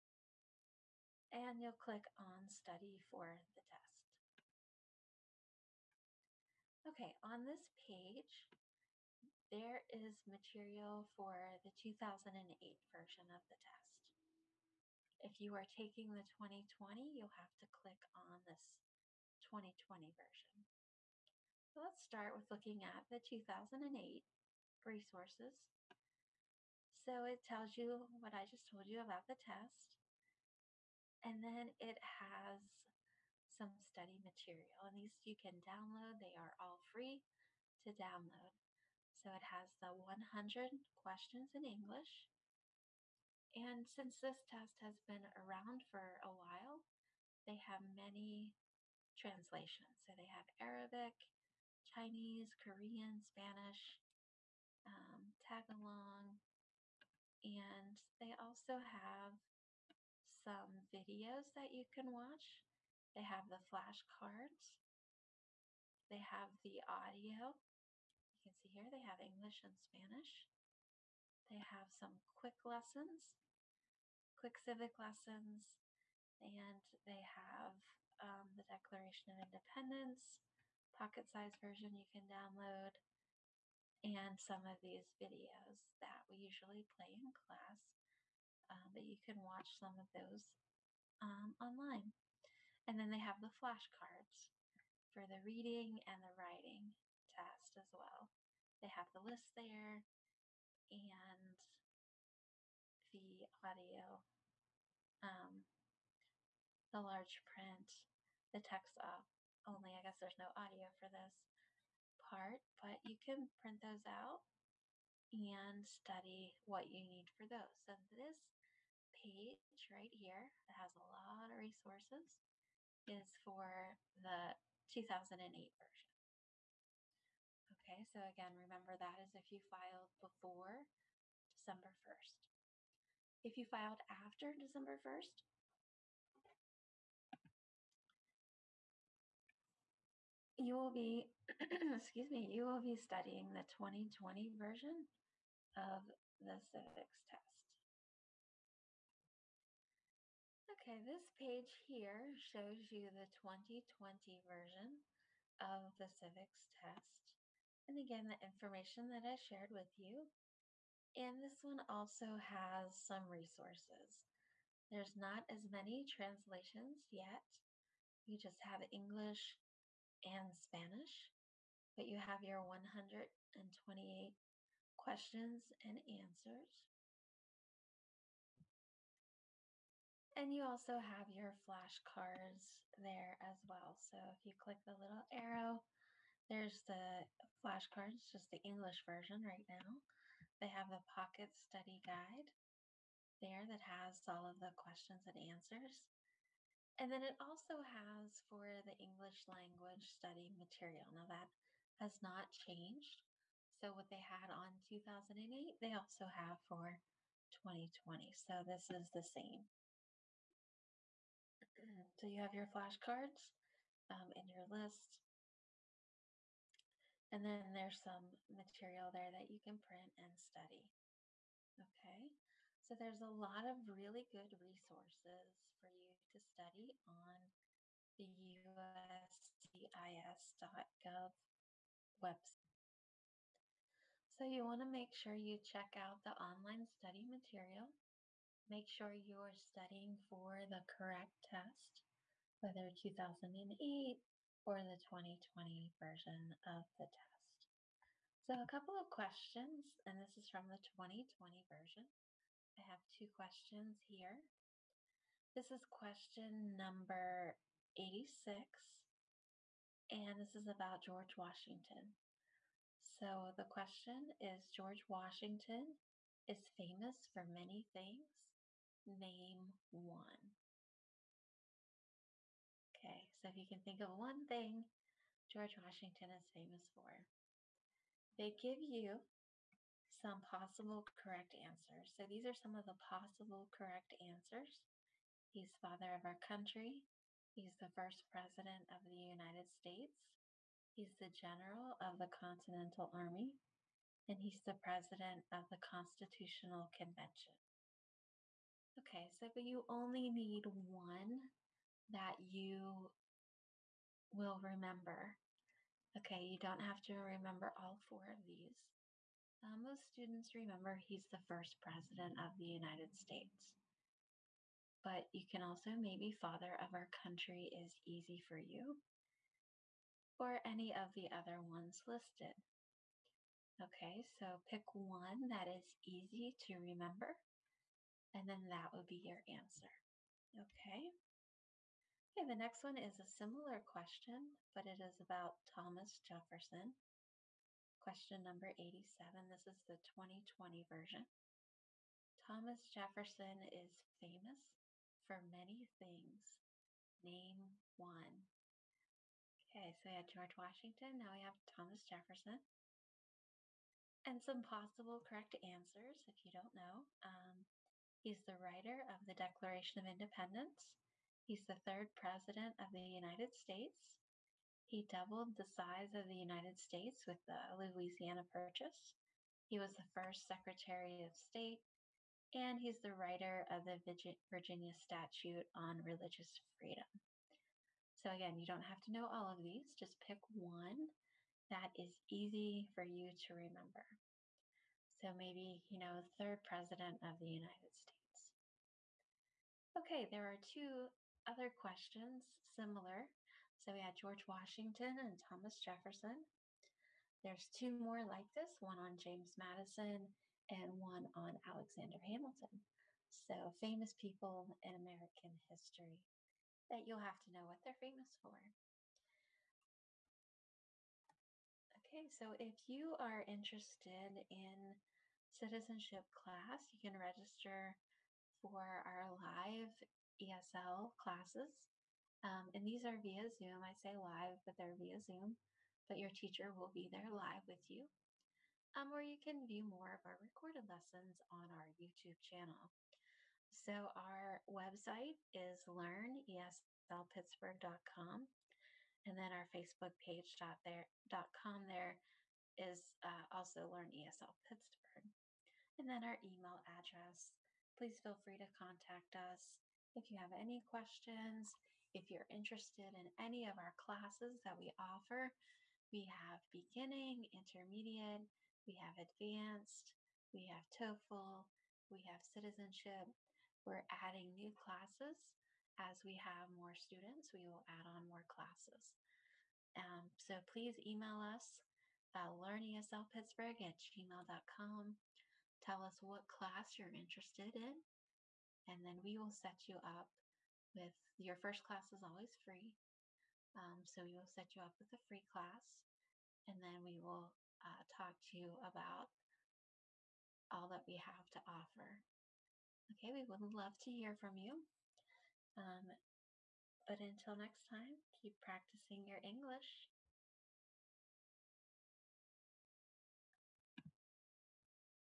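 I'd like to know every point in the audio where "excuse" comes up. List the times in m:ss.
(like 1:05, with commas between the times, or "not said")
2:21.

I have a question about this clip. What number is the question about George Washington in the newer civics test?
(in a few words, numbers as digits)
86.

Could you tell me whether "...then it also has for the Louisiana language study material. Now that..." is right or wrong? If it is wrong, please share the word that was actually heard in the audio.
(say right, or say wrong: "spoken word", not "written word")
wrong: "English", not "Louisiana".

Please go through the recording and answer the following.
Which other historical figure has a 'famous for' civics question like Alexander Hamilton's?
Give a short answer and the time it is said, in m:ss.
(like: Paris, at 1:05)
James Madison, at 6:39.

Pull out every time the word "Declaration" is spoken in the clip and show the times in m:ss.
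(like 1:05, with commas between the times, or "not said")
1:18, 5:59.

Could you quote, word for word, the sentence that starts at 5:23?
Okay, so pick one that is easy to remember and then that would be your answer.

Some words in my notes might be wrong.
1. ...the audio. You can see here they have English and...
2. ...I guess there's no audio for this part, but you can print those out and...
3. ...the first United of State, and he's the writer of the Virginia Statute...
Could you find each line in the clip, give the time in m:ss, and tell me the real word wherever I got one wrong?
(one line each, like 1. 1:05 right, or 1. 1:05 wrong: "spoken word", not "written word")
1. 1:06 right
2. 1:49 right
3. 6:09 wrong: "Secretary", not "United".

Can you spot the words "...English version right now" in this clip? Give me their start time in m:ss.
3:08.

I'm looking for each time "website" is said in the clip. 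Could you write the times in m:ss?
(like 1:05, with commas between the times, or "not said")
3:52, 7:14.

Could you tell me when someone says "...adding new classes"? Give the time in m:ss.
7:44.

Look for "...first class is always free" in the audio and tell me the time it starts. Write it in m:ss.
8:01.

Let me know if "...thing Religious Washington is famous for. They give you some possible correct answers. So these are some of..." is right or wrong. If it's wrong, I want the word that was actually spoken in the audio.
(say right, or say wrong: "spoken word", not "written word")
wrong: "George", not "Religious".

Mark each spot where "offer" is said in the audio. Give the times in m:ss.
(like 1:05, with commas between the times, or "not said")
7:34, 8:11.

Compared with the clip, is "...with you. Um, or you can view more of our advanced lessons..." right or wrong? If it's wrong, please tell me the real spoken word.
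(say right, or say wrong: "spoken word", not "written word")
wrong: "recorded", not "advanced".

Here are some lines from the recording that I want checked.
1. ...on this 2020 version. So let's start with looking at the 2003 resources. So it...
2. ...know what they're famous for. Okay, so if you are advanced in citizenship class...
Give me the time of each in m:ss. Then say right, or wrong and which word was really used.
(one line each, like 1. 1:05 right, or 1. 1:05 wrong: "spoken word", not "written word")
1. 0:18 wrong: "2008", not "2003"
2. 6:47 wrong: "interested", not "advanced".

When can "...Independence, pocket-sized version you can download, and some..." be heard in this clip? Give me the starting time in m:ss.
1:19.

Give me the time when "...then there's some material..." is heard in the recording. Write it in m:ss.
3:37.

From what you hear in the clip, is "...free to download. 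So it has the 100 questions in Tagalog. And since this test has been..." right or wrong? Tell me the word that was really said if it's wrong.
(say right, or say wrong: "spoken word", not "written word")
wrong: "English", not "Tagalog".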